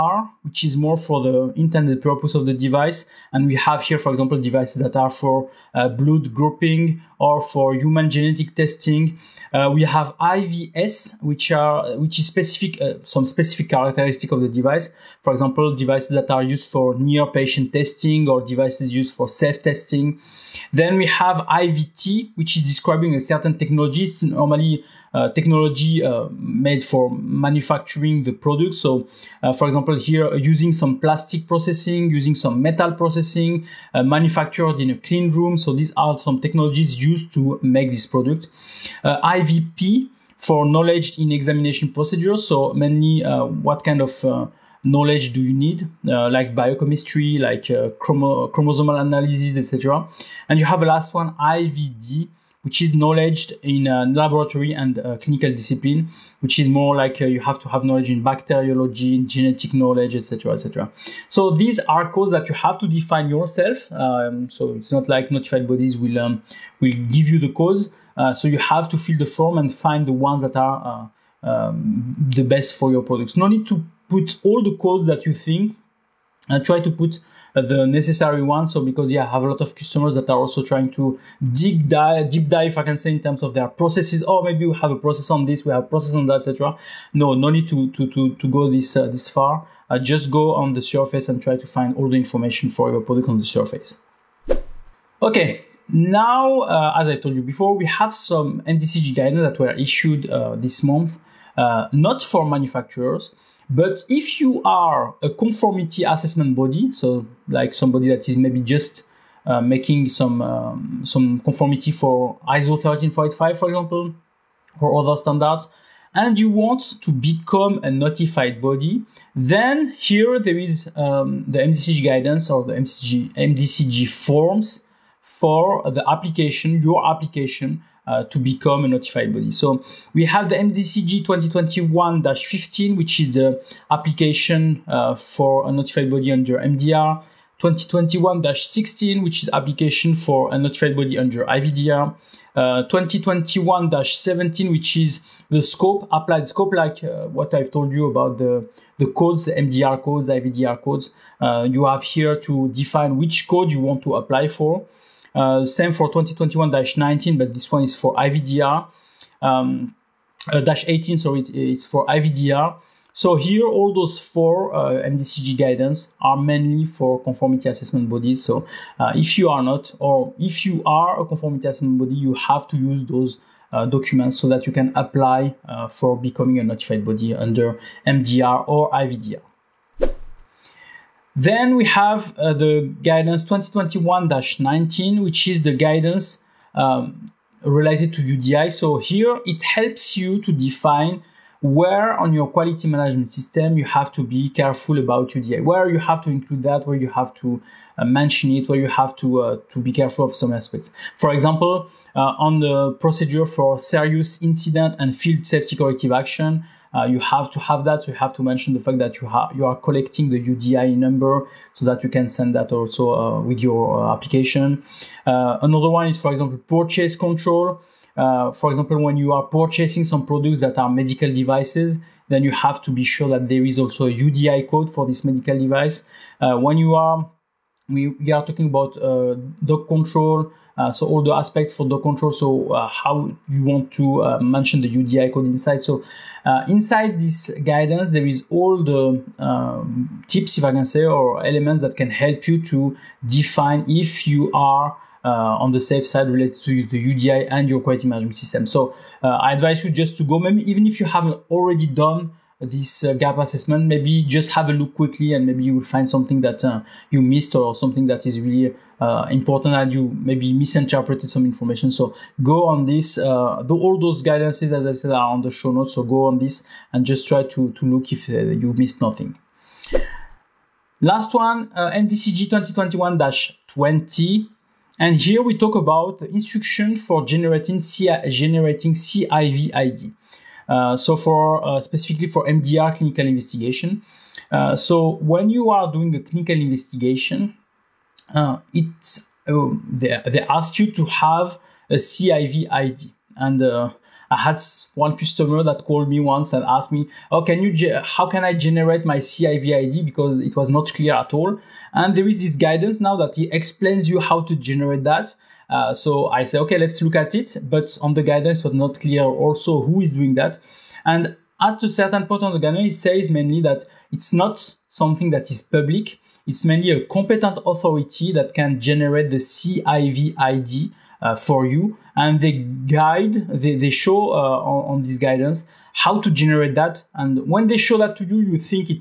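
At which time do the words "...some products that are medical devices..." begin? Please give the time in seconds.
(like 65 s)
220 s.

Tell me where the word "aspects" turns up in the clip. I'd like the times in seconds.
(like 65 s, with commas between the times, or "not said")
200 s, 231 s.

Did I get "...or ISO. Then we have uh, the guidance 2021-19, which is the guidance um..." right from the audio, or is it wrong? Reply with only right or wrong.
wrong.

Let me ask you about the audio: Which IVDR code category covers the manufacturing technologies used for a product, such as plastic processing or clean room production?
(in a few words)
IVT.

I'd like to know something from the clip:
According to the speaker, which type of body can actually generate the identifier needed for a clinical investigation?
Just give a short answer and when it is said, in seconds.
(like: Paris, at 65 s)
Competent authority, at 317 s.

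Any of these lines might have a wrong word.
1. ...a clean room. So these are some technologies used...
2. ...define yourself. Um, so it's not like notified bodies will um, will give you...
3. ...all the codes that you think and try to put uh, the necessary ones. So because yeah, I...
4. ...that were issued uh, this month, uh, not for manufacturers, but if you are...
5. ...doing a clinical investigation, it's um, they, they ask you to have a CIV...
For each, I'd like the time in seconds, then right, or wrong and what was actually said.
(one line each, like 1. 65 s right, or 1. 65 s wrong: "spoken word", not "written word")
1. 34 s right
2. 62 s right
3. 74 s right
4. 99 s right
5. 285 s right.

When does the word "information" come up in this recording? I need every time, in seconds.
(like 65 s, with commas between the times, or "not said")
92 s, 261 s.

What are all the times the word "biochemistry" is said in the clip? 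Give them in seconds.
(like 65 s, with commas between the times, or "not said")
46 s.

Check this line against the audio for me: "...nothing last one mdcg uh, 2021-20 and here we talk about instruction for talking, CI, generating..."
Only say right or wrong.
wrong.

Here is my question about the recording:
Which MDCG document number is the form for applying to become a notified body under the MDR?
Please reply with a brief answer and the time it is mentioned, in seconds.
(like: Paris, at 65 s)
MDCG 2021-15, at 131 s.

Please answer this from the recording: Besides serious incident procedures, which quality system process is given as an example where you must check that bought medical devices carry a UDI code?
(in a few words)
Purchase control.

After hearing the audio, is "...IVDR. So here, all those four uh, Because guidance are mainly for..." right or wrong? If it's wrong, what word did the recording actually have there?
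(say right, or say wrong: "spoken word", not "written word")
wrong: "MDCG", not "Because".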